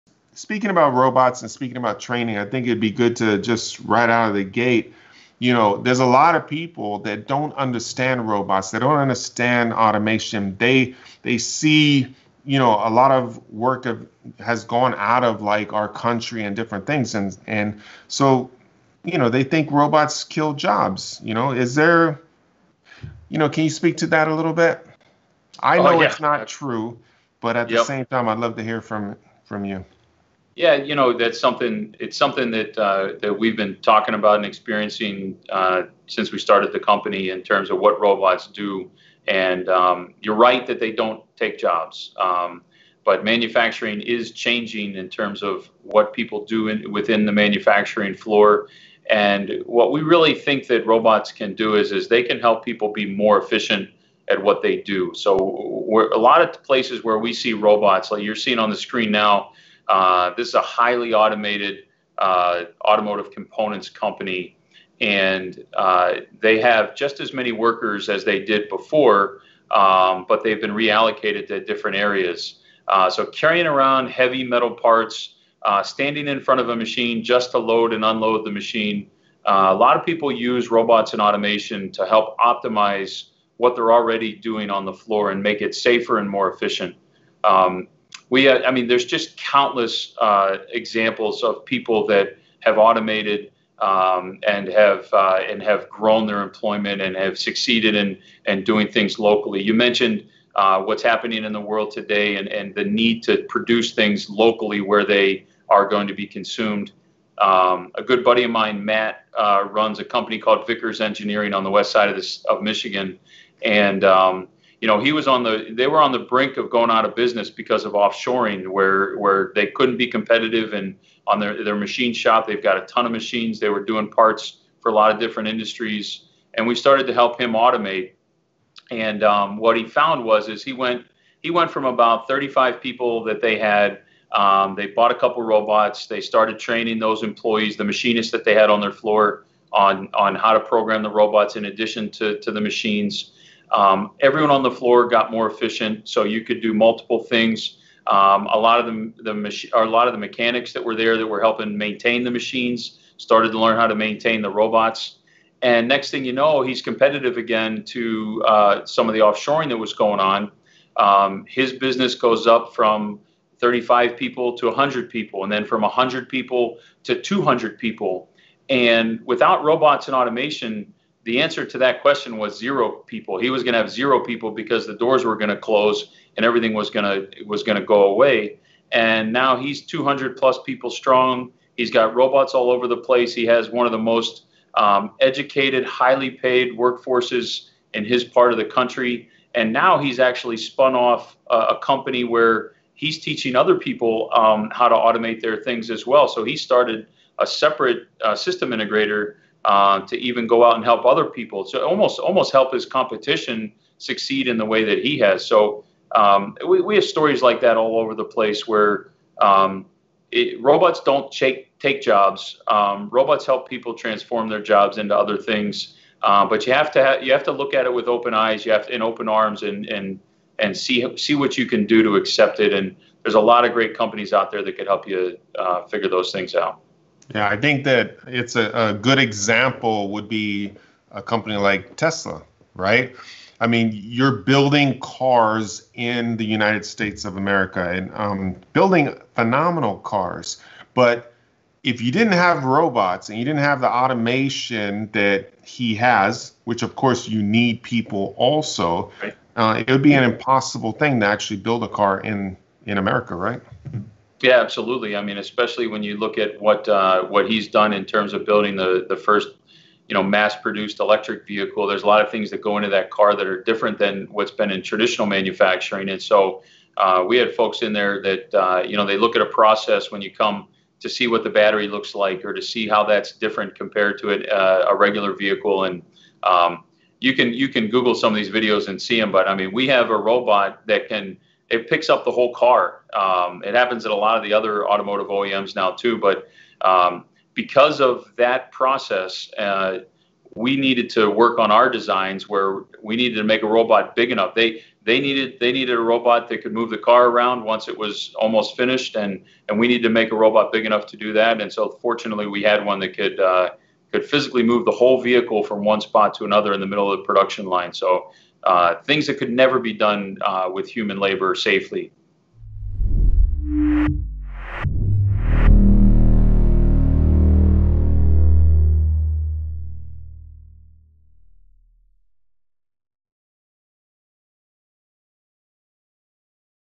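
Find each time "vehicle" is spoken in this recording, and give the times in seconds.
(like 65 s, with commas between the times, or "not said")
261 s, 275 s, 305 s.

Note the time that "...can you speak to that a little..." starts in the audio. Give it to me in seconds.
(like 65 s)
23 s.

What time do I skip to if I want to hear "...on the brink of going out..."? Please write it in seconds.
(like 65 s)
116 s.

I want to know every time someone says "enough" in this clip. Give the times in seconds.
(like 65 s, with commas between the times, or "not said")
294 s, 300 s.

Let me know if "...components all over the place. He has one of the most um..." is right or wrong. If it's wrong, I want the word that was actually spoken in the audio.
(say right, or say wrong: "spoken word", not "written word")
wrong: "robots", not "components".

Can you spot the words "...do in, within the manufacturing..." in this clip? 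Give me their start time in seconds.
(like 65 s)
46 s.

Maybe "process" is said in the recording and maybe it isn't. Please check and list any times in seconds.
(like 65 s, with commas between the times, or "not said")
269 s, 288 s.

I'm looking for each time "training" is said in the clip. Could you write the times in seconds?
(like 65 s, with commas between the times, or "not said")
1 s, 136 s.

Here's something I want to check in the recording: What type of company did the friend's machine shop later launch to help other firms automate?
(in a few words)
System integrator.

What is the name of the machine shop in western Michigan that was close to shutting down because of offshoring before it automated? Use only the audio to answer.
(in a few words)
Vickers Engineering.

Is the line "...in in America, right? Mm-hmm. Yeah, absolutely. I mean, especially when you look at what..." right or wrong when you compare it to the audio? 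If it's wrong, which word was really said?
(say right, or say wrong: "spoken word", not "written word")
right.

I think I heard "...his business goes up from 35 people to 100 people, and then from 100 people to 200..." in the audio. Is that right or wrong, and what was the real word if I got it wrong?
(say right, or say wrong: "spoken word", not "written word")
right.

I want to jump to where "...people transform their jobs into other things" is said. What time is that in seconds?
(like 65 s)
213 s.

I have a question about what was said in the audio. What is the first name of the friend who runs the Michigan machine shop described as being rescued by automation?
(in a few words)
Matt.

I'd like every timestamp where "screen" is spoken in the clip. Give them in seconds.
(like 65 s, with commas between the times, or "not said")
58 s.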